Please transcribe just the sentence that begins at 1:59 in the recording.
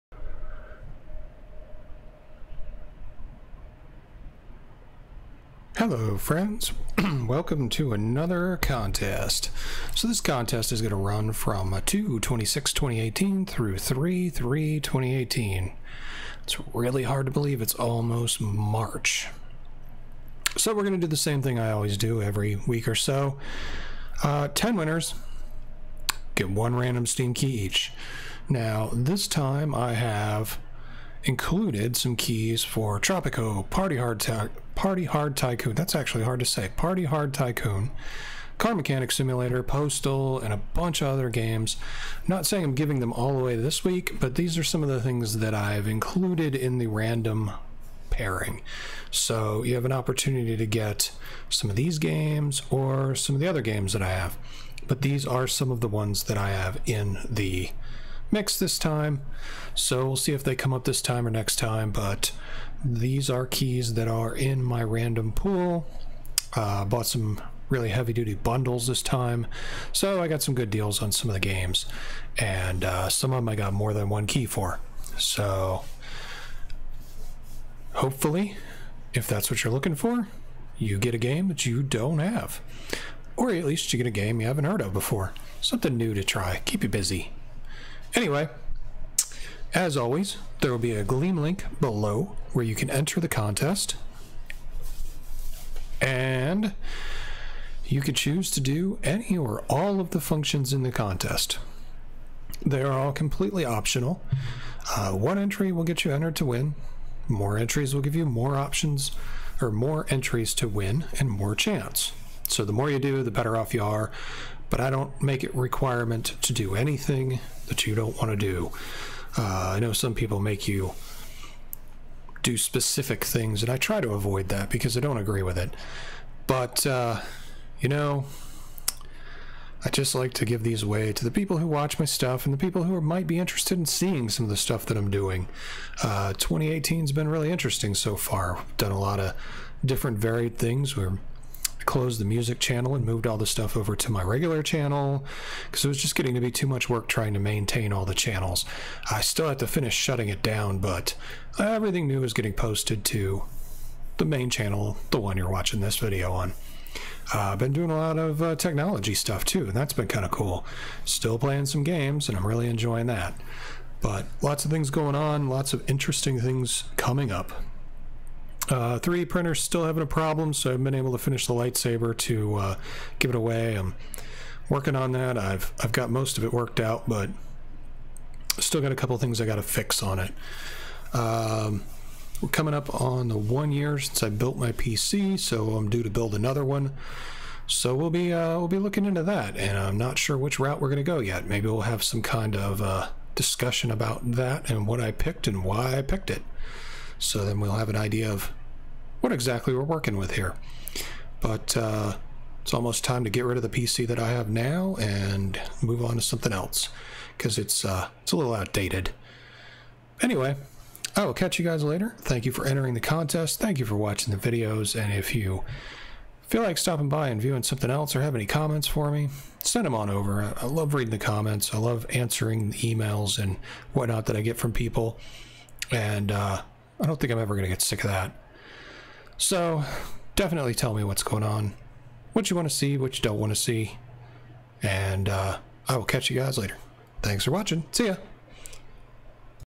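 Uh, I know some people make you do specific things, and I try to avoid that because I don't agree with it.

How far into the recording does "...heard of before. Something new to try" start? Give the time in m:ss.
1:24.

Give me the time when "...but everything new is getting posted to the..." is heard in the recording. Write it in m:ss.
2:30.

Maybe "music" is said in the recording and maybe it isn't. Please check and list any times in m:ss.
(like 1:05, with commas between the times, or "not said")
2:22.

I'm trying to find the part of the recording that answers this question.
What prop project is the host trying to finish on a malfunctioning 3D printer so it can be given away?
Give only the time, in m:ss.
2:51.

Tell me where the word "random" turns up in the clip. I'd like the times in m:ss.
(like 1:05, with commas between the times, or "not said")
0:26, 0:46, 1:04.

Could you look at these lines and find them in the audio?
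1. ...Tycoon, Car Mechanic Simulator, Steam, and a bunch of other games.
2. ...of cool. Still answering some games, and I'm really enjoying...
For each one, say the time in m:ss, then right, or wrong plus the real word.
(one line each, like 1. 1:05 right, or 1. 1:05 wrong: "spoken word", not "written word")
1. 0:37 wrong: "Postal", not "Steam"
2. 2:40 wrong: "playing", not "answering".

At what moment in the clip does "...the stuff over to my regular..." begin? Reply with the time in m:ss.
2:23.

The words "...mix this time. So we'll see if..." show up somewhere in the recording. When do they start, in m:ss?
0:58.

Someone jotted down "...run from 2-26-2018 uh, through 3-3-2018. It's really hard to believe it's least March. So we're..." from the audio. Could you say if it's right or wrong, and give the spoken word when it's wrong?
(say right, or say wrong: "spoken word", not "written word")
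wrong: "almost", not "least".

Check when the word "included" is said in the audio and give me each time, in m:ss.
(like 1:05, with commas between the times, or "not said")
0:31, 0:45.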